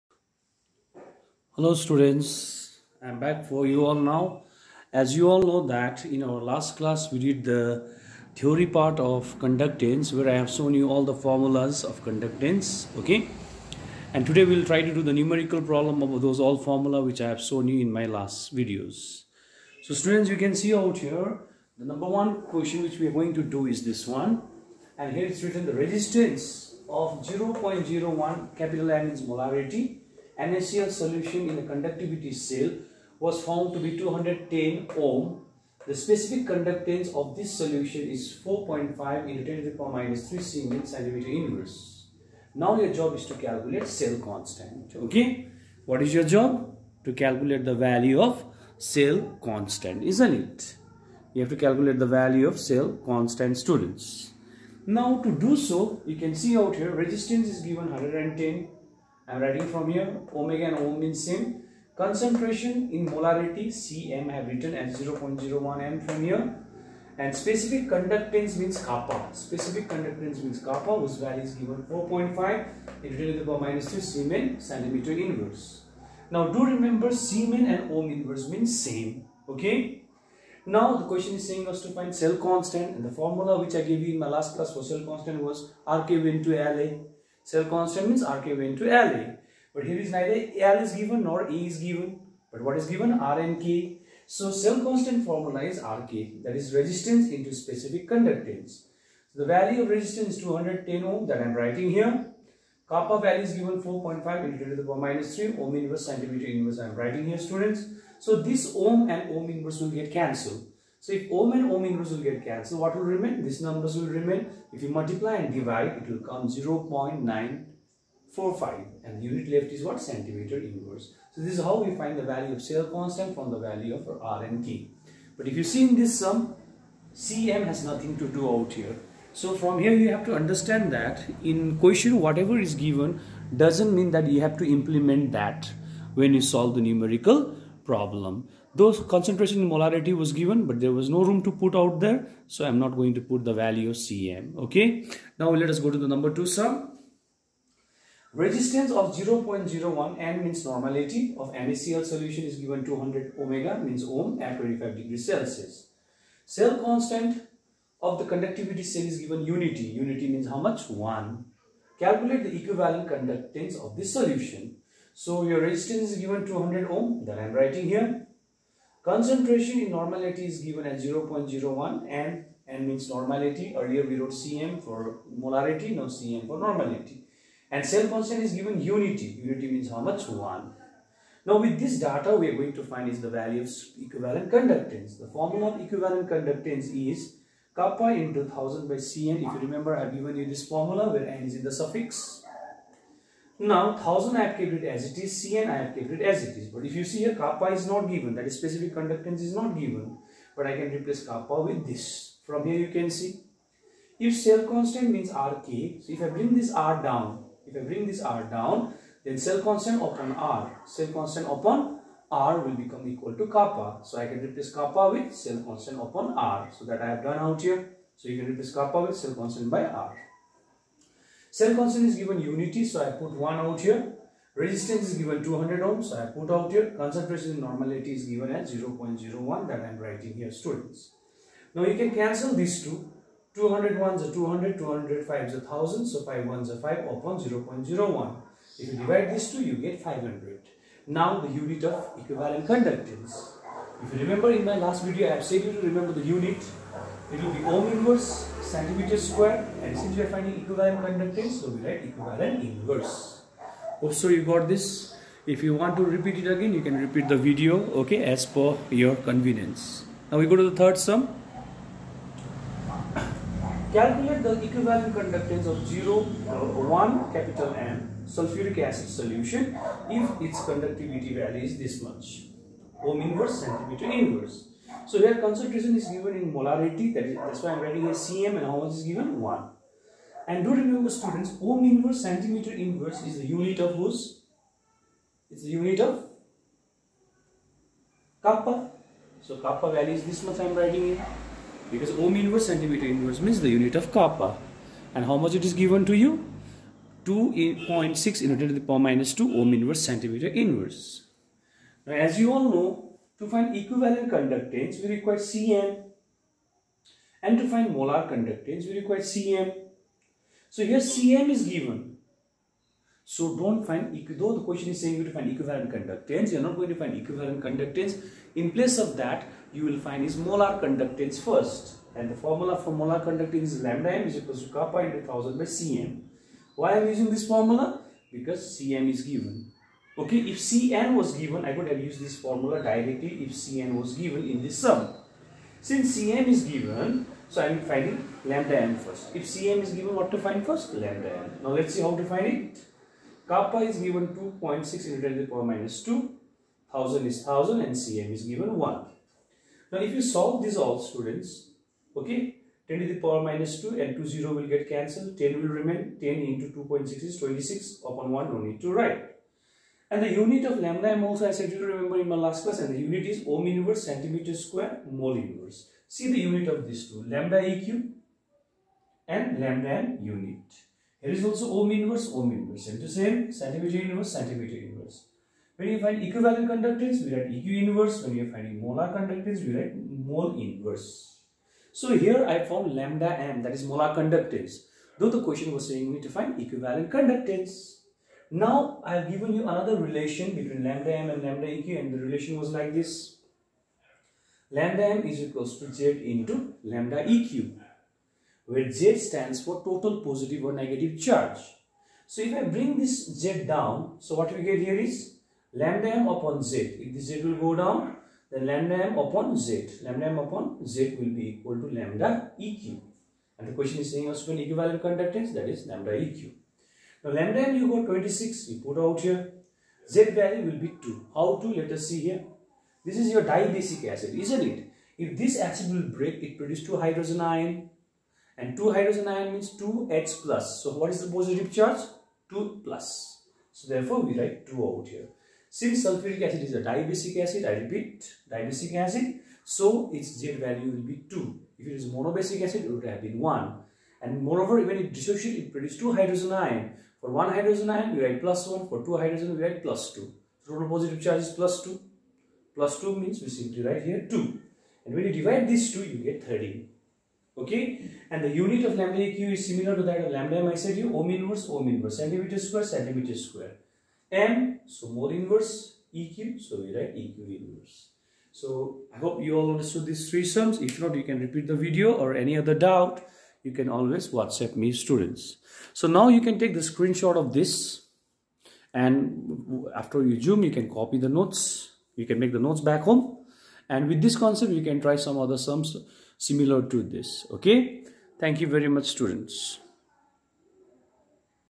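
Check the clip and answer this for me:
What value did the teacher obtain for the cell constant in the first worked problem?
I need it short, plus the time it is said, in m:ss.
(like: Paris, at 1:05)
0.945, at 1:56.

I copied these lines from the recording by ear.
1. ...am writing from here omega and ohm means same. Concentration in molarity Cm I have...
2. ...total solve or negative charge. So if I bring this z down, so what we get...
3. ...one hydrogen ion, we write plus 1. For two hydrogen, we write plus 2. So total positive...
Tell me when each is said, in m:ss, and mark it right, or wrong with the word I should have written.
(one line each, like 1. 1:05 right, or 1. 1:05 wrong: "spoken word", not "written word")
1. 0:59 right
2. 6:39 wrong: "positive", not "solve"
3. 7:27 right.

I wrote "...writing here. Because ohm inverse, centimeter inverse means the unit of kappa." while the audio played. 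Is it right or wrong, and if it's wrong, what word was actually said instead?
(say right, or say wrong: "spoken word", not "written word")
right.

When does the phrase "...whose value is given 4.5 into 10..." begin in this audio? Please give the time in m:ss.
1:11.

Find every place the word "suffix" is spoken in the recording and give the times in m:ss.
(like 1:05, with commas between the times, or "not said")
3:11.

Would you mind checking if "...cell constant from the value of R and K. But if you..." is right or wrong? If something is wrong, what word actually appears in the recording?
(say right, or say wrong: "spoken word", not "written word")
right.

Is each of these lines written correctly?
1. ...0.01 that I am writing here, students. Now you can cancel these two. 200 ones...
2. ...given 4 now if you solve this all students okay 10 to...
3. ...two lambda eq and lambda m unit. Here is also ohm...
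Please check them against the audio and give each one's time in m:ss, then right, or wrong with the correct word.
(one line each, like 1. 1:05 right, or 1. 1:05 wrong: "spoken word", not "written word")
1. 3:48 right
2. 5:48 wrong: "1", not "4"
3. 6:07 right.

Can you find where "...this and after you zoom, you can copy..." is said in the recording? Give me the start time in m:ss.
7:57.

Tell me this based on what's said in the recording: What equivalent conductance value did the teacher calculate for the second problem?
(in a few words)
500.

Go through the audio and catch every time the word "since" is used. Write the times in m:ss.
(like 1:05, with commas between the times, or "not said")
4:09, 5:35, 7:15.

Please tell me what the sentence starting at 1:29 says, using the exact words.
But here is neither L is given nor E is given.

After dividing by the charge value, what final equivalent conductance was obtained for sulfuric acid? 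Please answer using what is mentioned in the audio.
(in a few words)
13.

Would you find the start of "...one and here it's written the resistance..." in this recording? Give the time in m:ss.
0:24.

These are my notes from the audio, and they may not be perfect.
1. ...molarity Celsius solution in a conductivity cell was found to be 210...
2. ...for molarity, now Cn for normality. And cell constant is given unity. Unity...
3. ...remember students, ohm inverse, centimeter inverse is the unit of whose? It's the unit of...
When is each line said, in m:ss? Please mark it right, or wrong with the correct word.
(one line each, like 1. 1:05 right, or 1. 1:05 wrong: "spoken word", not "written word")
1. 0:29 wrong: "NaCl", not "Celsius"
2. 2:54 right
3. 4:40 right.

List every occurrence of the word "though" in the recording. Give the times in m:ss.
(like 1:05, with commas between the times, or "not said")
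5:14, 6:25.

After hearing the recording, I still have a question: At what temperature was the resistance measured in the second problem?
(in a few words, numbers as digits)
25 degrees Celsius.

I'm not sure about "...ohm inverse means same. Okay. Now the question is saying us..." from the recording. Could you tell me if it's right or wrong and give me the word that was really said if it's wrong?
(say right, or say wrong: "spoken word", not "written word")
right.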